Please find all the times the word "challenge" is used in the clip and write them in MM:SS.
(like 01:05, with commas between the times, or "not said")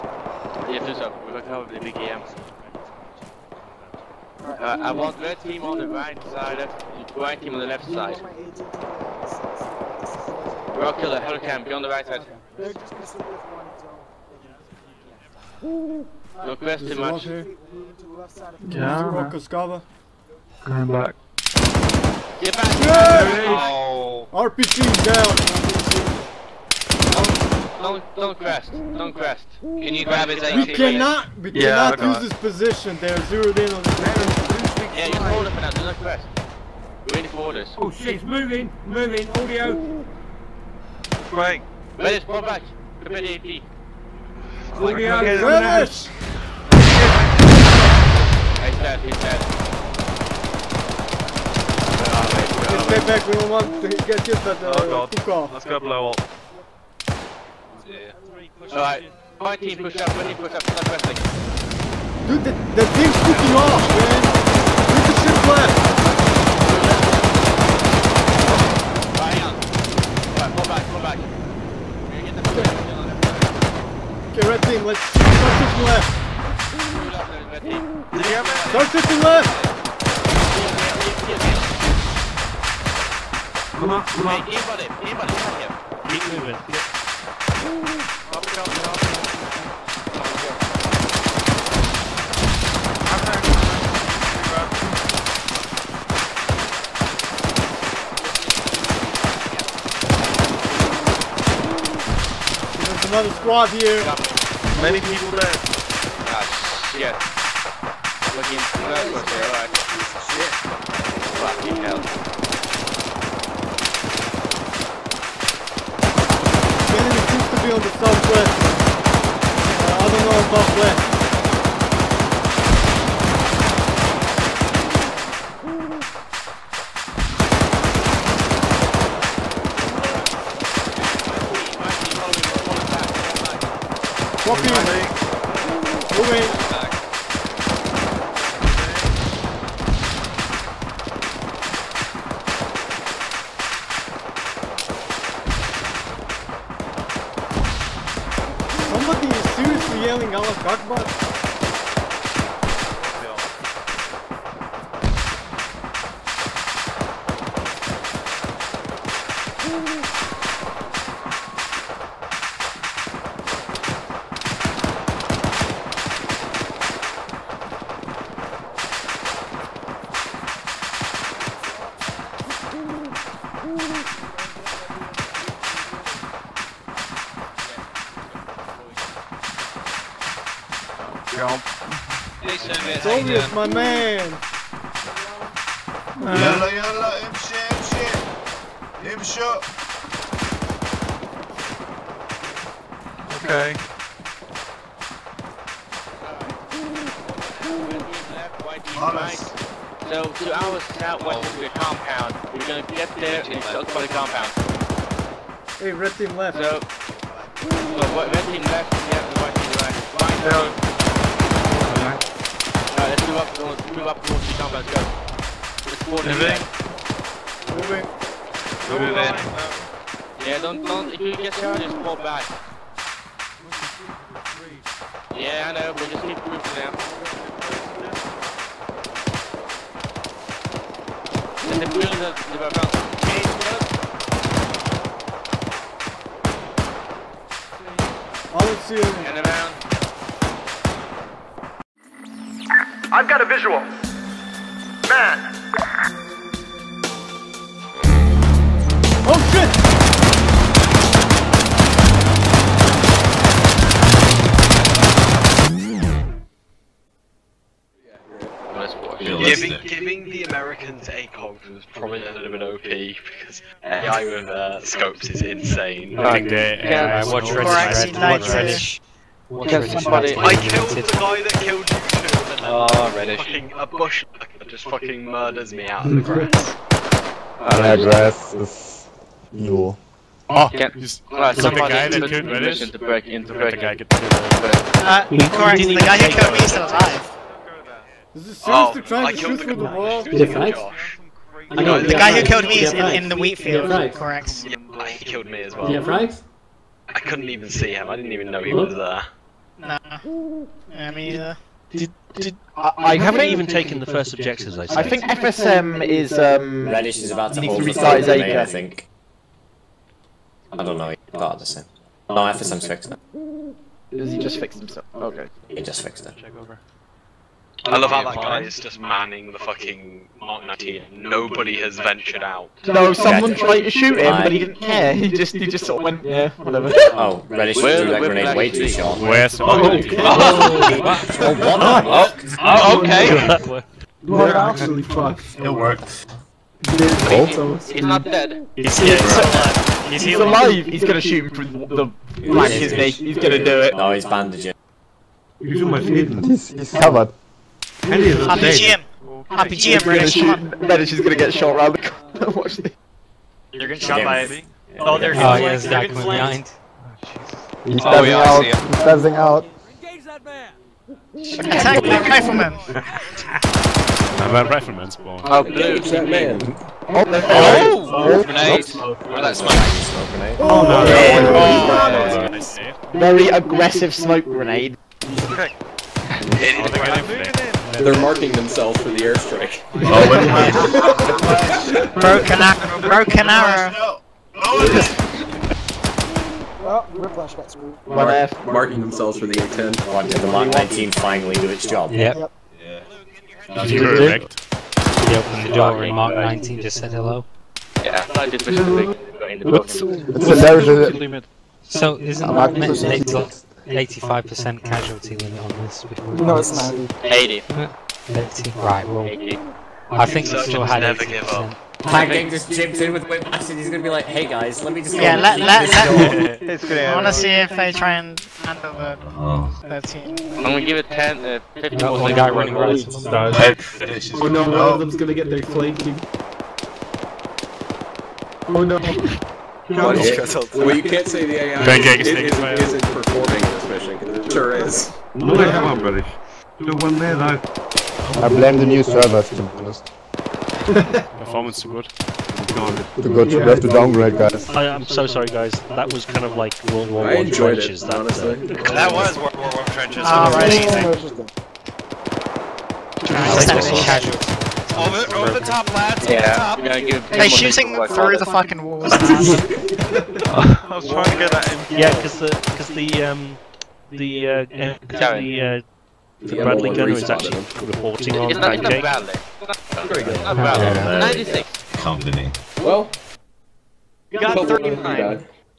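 not said.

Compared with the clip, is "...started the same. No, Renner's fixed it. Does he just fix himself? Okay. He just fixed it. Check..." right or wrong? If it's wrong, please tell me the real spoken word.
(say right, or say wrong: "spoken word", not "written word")
wrong: "FSM", not "Renner".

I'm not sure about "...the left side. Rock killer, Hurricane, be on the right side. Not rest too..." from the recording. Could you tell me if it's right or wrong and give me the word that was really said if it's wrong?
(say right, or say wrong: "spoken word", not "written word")
right.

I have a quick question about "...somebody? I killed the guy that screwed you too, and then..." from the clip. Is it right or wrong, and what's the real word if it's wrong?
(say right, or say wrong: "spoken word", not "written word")
wrong: "killed", not "screwed".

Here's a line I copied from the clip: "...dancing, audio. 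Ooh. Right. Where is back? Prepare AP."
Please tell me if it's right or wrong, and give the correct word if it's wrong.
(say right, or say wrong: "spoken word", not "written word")
wrong: "moving", not "dancing".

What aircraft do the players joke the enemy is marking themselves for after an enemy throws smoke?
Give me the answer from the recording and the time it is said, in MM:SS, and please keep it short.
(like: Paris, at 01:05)
A10, at 06:29.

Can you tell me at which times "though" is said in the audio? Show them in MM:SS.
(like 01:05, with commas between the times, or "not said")
07:17.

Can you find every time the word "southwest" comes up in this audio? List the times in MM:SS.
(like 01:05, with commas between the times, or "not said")
01:57, 03:20.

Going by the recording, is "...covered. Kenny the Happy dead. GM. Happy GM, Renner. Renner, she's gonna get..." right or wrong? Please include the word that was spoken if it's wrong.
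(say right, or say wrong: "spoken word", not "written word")
right.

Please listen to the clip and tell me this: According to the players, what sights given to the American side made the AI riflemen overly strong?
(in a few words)
ACOGs.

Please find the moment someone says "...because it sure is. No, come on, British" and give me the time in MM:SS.
07:14.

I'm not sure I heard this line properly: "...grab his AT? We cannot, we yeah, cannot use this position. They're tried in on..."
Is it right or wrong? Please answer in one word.
wrong.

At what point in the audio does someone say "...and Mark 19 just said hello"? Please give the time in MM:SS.
06:36.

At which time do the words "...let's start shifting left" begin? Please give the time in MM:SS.
01:14.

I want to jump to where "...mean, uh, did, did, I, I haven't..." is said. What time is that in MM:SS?
05:01.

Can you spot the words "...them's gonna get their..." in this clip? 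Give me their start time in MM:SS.
07:04.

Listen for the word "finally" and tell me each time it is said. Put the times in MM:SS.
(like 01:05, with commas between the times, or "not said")
06:31.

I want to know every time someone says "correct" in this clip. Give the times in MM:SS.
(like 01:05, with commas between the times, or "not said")
04:45, 04:54.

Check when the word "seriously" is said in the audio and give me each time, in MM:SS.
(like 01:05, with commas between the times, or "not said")
02:29, 04:48.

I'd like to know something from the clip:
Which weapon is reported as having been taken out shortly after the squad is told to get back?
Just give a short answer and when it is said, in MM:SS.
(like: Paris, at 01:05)
RPG, at 00:24.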